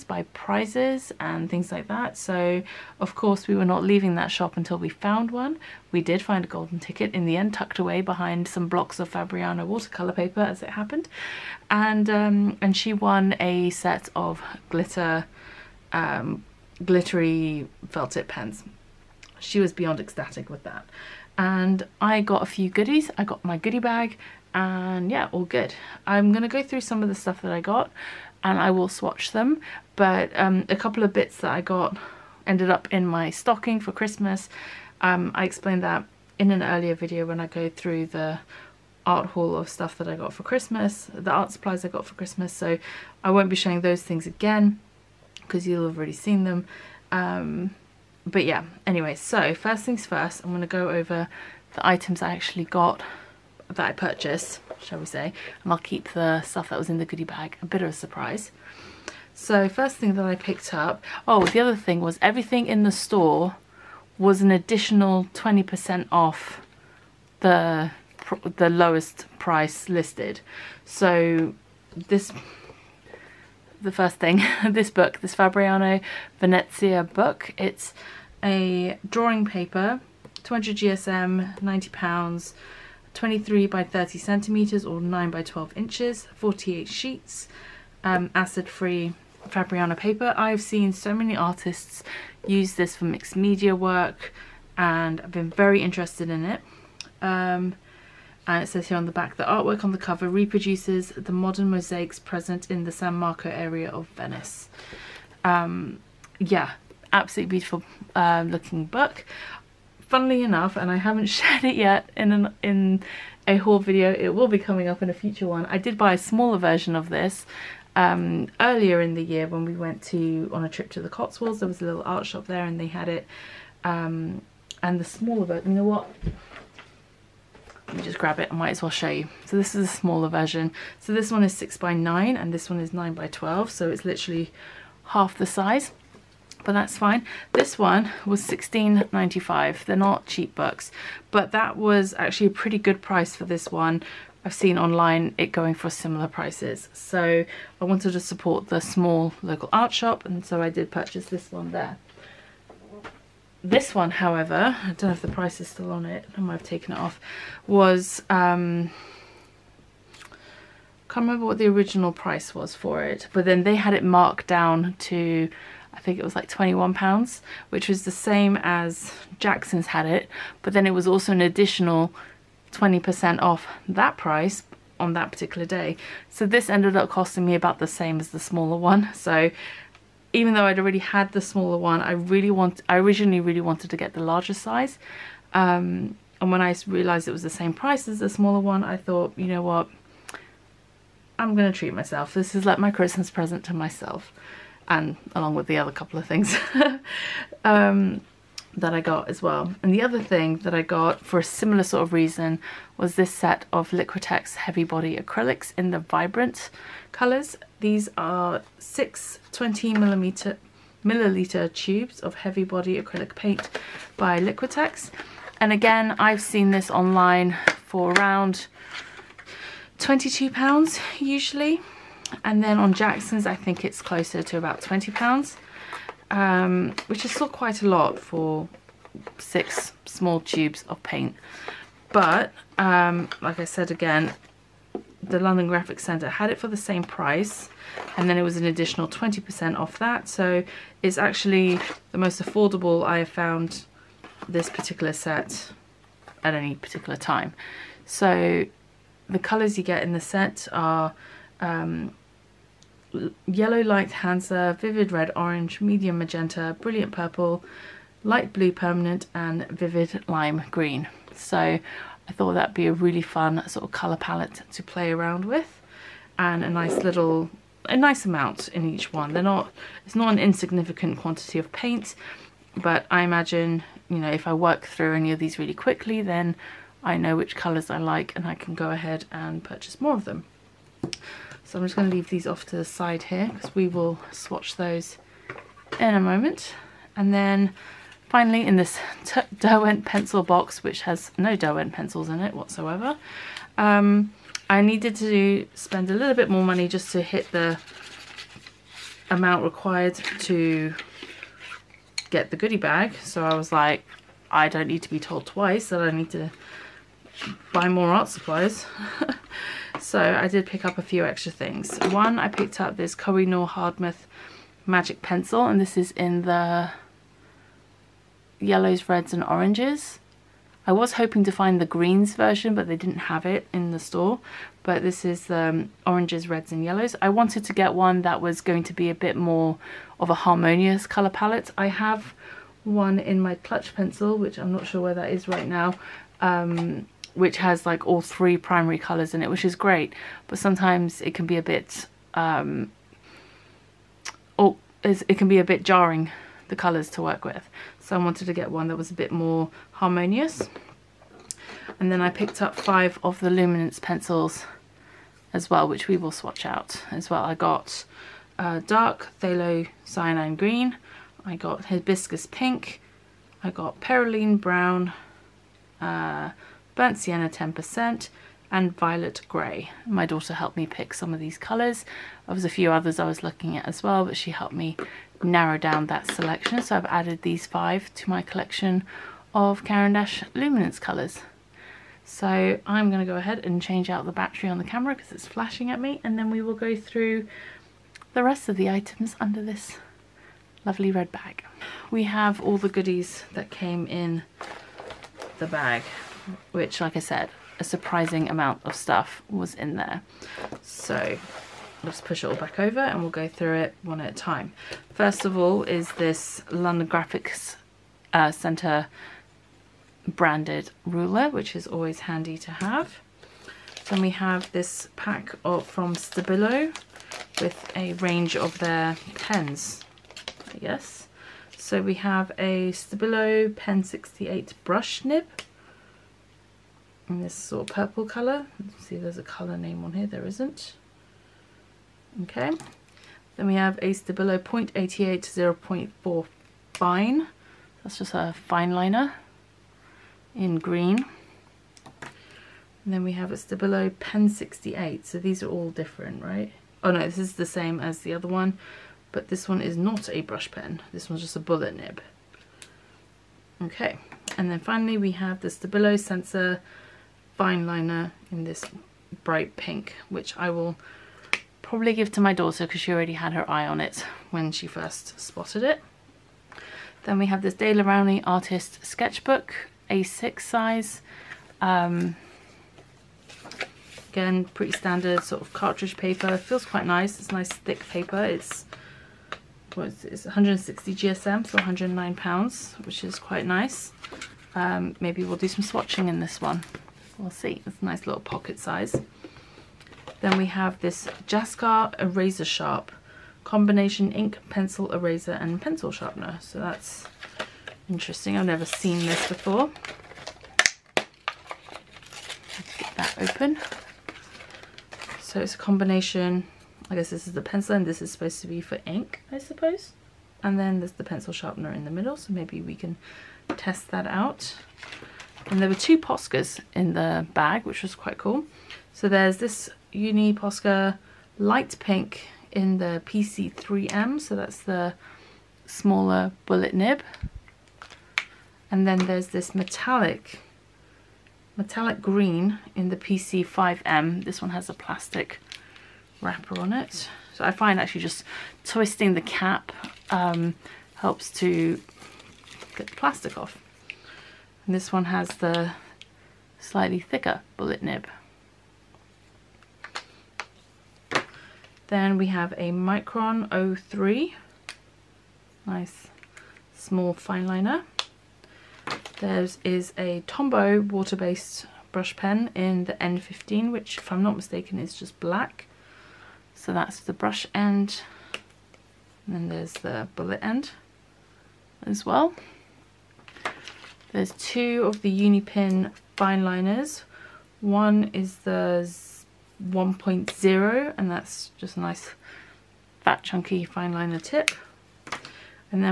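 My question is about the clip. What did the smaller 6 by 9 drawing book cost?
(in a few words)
$16.95.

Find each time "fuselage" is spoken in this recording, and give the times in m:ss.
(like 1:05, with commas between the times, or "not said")
not said.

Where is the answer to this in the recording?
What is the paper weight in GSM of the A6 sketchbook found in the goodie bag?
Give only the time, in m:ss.
8:00.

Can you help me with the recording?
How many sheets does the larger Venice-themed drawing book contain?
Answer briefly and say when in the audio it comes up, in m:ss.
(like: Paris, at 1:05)
48, at 1:26.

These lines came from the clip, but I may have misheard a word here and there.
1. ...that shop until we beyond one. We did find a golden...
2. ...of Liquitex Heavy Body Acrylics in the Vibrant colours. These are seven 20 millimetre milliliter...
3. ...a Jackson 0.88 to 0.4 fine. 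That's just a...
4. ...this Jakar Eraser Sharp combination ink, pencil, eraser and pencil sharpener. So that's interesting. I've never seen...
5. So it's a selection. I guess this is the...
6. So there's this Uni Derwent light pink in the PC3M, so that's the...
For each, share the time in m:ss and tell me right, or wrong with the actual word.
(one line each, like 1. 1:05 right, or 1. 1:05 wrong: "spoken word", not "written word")
1. 0:04 wrong: "found", not "beyond"
2. 3:23 wrong: "six", not "seven"
3. 7:13 wrong: "Stabilo", not "Jackson"
4. 8:11 right
5. 8:25 wrong: "combination", not "selection"
6. 8:39 wrong: "Posca", not "Derwent".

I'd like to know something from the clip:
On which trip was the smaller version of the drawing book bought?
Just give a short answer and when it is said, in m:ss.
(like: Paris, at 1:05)
the Cotswolds, at 2:01.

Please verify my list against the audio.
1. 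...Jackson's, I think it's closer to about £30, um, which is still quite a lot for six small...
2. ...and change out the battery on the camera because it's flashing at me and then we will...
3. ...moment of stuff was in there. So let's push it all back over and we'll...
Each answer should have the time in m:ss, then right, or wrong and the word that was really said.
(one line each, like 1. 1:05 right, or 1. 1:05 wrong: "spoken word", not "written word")
1. 3:42 wrong: "20", not "30"
2. 6:23 right
3. 6:38 wrong: "amount", not "moment".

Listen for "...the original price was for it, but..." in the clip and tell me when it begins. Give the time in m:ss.
2:41.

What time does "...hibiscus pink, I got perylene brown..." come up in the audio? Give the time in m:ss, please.
6:01.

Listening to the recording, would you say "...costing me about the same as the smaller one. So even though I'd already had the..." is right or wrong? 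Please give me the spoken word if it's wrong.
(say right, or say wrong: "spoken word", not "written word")
right.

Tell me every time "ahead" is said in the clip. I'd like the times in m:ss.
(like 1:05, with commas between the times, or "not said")
4:38, 6:23.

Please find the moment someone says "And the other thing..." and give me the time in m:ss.
3:19.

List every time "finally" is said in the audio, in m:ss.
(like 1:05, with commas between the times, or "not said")
4:48, 7:34.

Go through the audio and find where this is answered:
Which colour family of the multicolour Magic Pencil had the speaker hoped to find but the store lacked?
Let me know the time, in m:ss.
5:21.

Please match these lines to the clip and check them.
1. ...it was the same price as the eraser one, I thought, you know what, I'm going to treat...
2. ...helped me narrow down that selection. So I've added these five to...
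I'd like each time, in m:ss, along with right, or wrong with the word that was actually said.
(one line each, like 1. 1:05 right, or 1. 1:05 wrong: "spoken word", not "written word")
1. 3:07 wrong: "smaller", not "eraser"
2. 6:14 right.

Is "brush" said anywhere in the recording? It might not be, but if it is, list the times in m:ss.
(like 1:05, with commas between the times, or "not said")
7:04, 7:30, 9:22, 9:27.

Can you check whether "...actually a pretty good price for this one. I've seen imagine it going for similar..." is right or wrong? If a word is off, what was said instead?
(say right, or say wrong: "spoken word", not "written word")
wrong: "online", not "imagine".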